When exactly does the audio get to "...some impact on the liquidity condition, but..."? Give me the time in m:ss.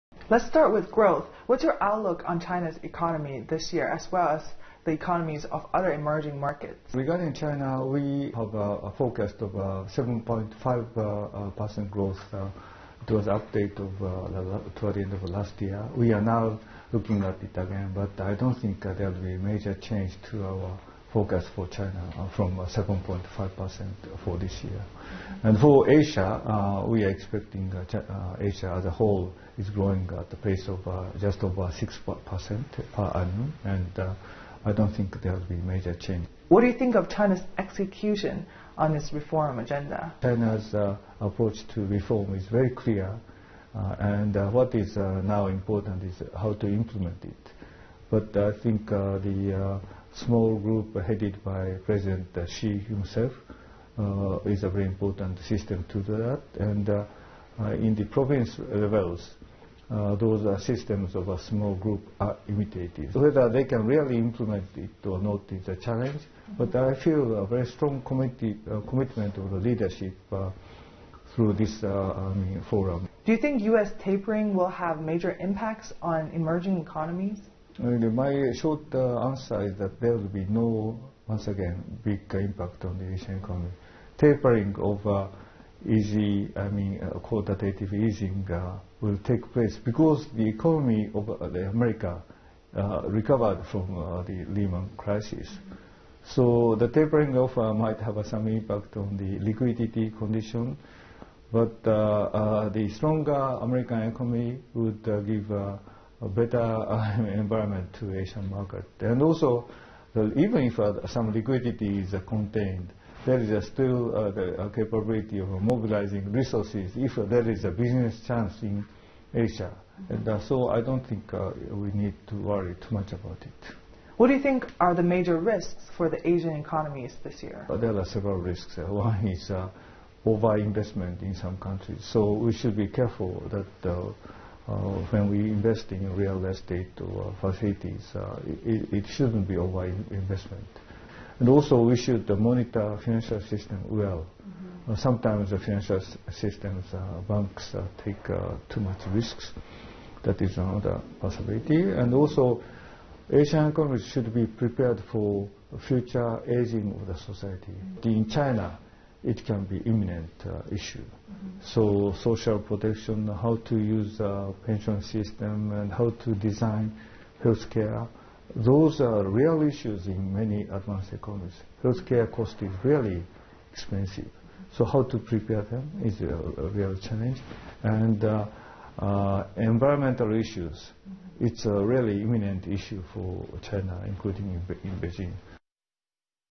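1:38.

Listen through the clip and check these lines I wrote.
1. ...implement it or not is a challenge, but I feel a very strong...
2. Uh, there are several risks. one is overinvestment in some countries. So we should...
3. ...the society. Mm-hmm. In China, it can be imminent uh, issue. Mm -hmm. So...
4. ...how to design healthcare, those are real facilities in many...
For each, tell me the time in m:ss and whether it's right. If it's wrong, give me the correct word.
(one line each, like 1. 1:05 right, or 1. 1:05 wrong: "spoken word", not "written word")
1. 1:04 right
2. 2:07 right
3. 2:37 right
4. 2:45 wrong: "issues", not "facilities".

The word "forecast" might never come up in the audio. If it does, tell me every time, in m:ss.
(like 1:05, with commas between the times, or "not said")
0:08, 0:21.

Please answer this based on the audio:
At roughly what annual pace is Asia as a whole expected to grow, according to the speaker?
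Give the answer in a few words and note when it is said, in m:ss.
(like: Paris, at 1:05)
just over 6%, at 0:31.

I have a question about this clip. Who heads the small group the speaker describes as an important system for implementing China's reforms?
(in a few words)
President Xi.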